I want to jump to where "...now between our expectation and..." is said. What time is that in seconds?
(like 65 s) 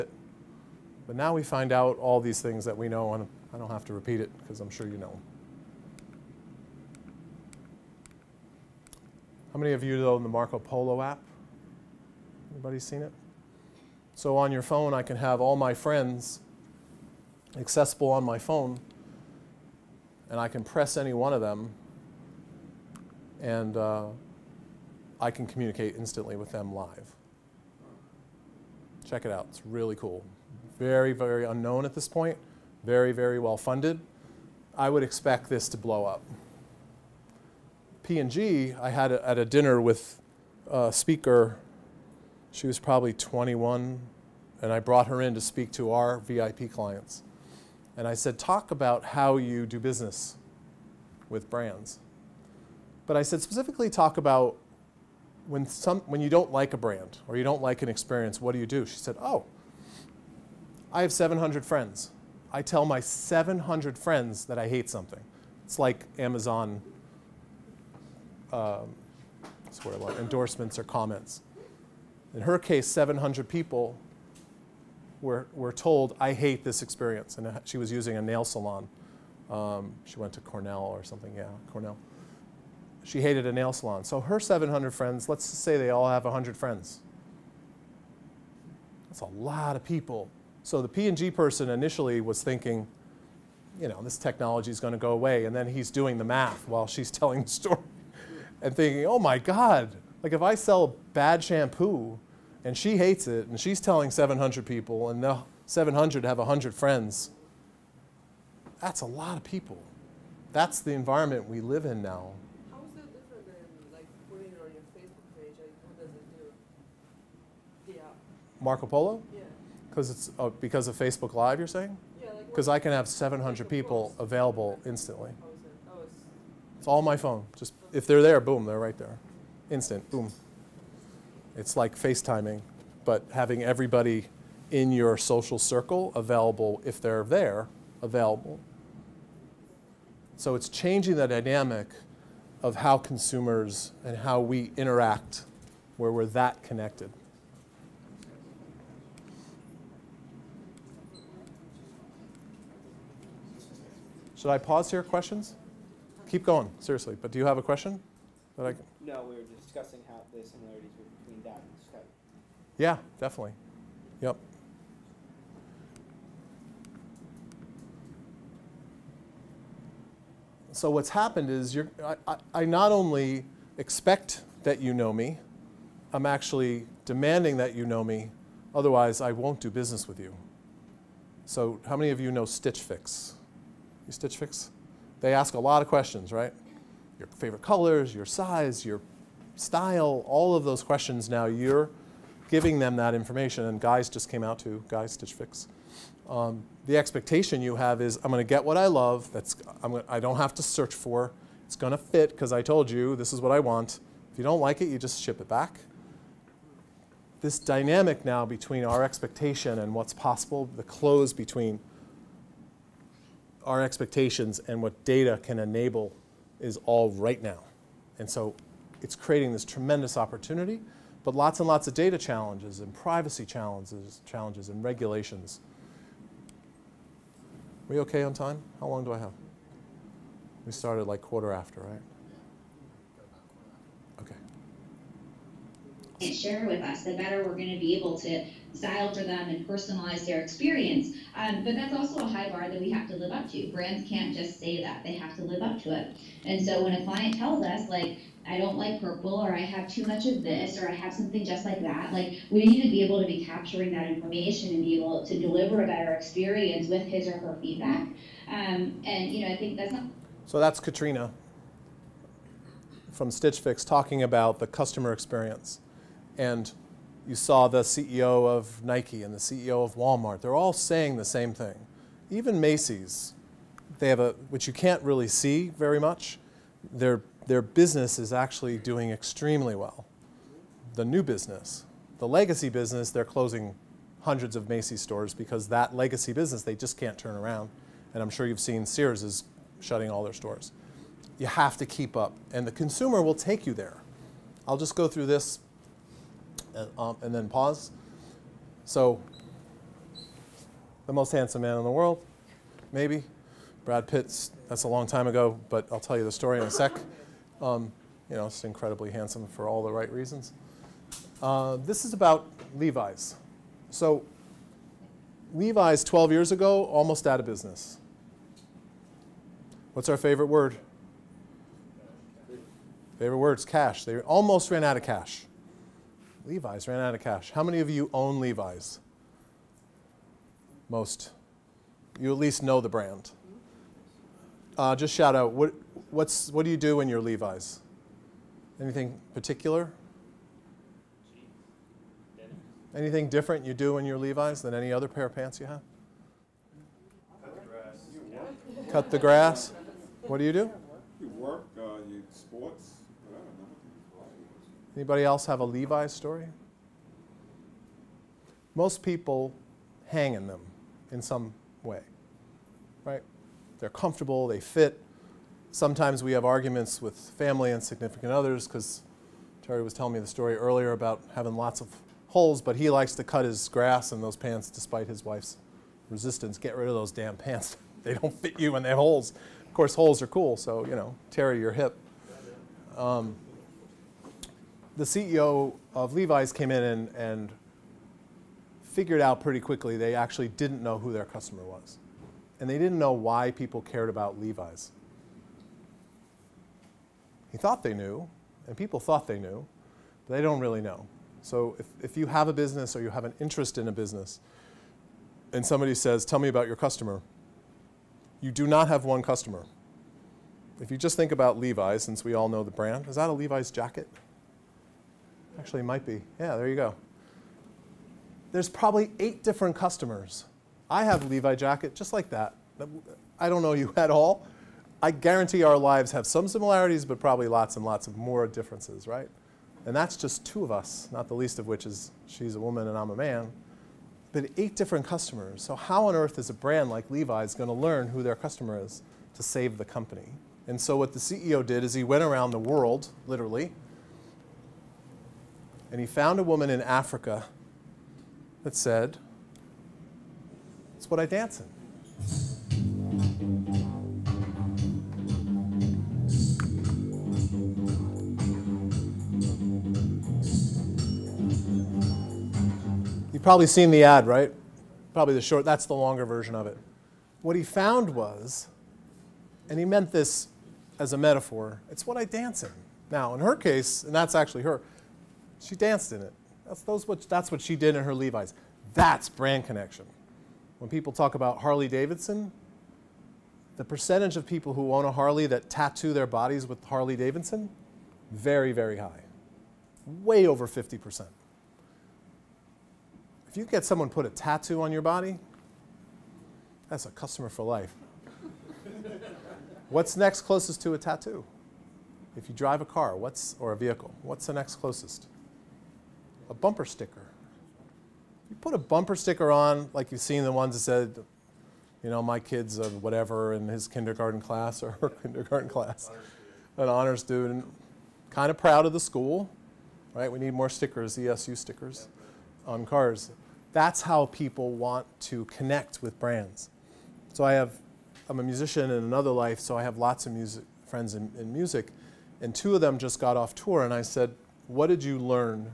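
208 s.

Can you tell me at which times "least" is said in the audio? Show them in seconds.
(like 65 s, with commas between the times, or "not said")
332 s, 431 s.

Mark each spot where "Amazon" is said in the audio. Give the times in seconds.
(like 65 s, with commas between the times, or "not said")
66 s.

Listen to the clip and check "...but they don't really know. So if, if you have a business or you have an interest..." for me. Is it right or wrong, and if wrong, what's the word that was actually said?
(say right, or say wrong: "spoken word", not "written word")
right.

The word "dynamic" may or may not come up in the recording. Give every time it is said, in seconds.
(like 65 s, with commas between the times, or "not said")
141 s, 207 s.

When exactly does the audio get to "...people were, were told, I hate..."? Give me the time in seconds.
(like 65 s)
73 s.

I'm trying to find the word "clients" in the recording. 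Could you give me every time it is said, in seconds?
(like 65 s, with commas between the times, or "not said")
46 s, 247 s.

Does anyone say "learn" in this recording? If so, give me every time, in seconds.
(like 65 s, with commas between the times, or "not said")
437 s, 535 s.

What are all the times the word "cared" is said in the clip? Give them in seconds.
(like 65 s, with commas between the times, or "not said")
393 s.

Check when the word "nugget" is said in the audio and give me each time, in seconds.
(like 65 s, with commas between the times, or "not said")
not said.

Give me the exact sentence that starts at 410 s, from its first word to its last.
If you just think about Levi's, since we all know the brand, is that a Levi's jacket?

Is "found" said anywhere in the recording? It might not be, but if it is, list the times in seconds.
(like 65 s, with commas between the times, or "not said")
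446 s, 467 s.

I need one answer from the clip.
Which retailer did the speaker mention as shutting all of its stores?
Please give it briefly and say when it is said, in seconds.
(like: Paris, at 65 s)
Sears, at 288 s.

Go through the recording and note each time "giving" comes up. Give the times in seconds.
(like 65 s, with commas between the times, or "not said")
192 s.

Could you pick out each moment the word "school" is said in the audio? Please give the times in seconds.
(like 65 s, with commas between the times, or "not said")
519 s.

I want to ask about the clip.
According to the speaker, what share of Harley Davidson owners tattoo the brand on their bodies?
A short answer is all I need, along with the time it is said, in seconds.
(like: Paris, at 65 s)
Over 50%, at 490 s.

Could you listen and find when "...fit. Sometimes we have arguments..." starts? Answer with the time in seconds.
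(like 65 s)
364 s.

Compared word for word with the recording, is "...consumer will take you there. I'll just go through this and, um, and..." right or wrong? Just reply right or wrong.
right.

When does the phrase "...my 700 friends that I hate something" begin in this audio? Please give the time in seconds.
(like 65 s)
62 s.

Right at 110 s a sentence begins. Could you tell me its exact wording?
That's the environment we live in now.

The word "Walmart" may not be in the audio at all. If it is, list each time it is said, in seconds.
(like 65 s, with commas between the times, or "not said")
269 s.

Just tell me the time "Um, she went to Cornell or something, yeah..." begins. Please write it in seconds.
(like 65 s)
79 s.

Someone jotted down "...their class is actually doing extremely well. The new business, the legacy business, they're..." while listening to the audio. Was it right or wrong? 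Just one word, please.
wrong.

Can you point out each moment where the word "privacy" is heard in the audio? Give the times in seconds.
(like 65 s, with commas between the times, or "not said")
222 s.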